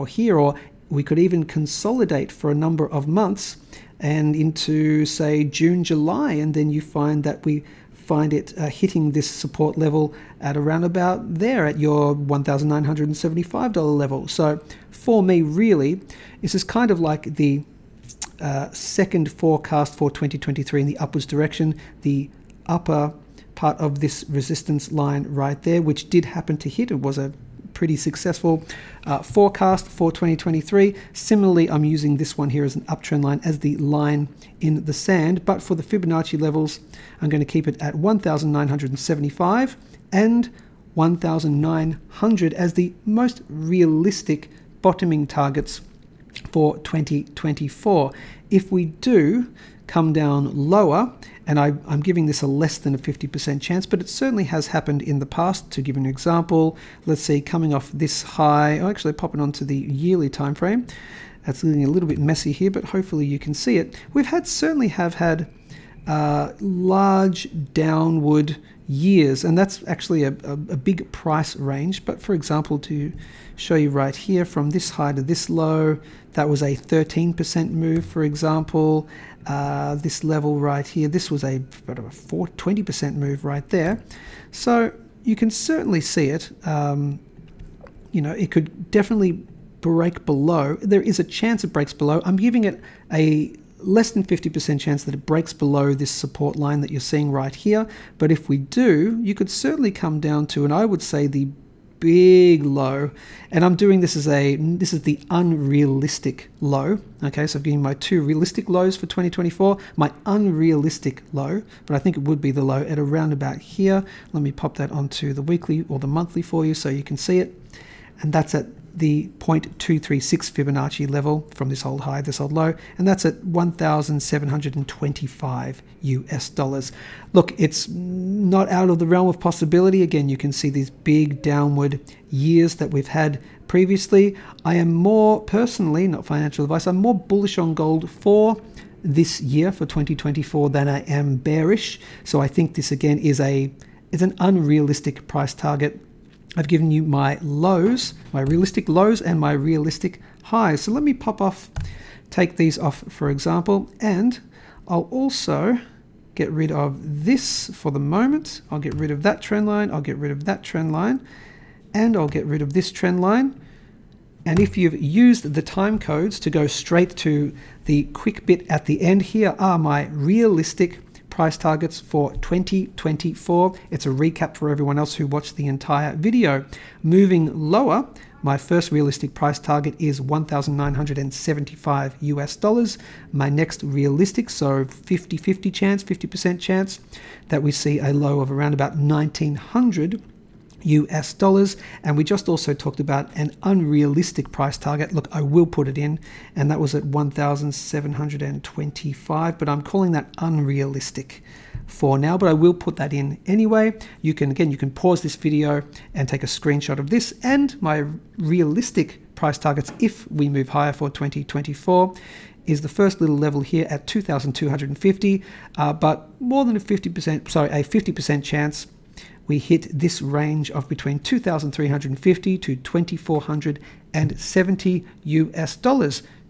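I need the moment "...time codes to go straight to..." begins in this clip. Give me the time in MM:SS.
02:45.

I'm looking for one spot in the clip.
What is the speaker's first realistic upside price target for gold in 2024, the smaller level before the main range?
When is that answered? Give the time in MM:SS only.
03:34.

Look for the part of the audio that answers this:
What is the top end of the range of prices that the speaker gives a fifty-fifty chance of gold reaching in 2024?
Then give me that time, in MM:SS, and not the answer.
03:42.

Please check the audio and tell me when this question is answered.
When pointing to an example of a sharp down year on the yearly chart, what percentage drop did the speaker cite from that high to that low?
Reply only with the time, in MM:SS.
01:16.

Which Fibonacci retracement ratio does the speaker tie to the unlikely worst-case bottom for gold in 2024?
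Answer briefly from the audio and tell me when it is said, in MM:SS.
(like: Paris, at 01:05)
0.236, at 01:59.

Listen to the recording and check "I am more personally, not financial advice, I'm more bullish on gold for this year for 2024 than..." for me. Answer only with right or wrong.
right.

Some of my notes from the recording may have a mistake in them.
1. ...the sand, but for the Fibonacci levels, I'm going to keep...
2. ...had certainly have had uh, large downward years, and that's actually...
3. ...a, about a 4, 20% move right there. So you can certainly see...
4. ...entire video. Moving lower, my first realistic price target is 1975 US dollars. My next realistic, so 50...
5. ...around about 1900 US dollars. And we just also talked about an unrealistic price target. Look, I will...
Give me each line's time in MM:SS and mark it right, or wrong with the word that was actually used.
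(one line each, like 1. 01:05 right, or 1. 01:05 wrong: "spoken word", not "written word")
1. 00:34 right
2. 01:04 right
3. 01:21 right
4. 02:55 right
5. 03:08 right.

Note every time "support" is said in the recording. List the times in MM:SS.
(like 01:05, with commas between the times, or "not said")
00:09, 01:36.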